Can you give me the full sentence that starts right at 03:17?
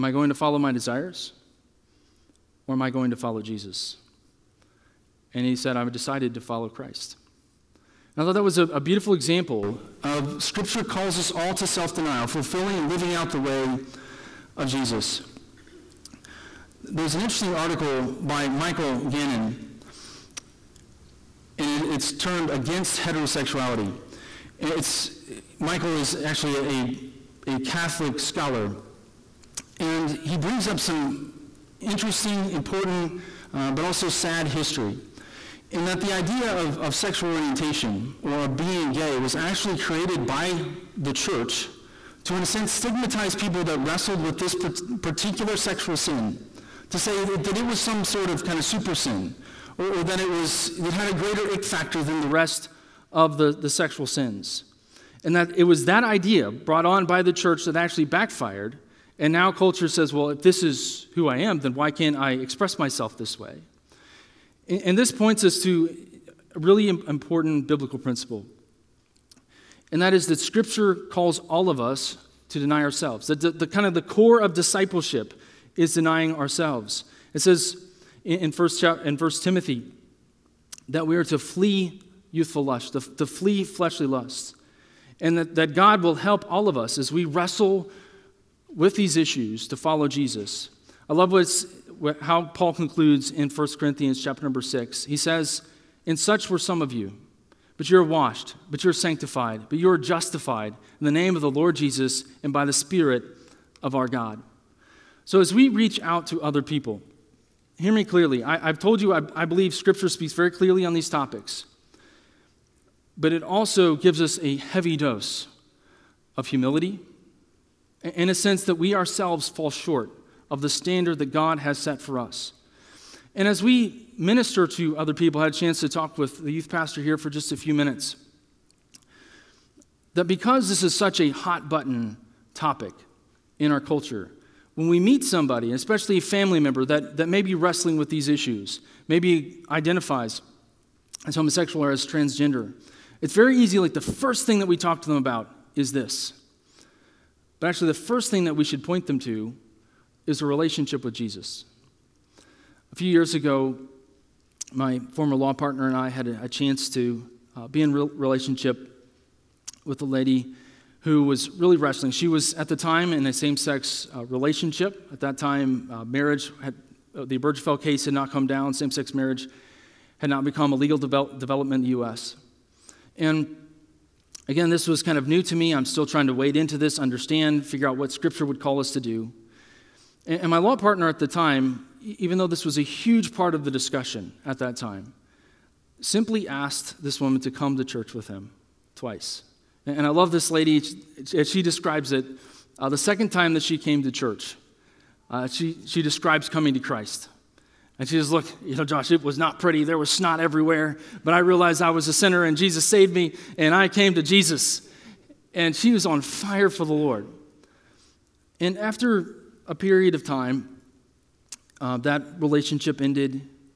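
And she says, Look, you know, Josh, it was not pretty.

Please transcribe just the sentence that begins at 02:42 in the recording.
She was at the time in a same-sex uh, relationship.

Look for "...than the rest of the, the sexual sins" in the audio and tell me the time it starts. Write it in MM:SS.
00:52.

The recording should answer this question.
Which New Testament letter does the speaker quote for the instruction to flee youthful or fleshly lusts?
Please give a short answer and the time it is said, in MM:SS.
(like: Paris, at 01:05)
1 Timothy, at 01:19.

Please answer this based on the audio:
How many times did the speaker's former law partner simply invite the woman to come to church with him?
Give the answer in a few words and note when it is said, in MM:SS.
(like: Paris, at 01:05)
2, at 03:08.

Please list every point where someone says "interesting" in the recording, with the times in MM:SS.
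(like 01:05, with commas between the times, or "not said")
00:17, 00:31.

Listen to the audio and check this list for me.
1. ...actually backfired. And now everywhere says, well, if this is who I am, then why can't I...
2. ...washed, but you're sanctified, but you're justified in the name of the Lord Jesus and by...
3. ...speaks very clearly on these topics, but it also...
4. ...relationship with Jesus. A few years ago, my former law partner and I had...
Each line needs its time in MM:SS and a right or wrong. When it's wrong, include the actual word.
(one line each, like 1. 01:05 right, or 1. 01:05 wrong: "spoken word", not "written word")
1. 00:57 wrong: "culture", not "everywhere"
2. 01:38 right
3. 01:50 right
4. 02:30 right.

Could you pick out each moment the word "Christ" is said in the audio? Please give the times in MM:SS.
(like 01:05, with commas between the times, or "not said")
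00:06, 03:16.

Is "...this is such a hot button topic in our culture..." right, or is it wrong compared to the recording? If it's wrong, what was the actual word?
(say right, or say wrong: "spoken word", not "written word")
right.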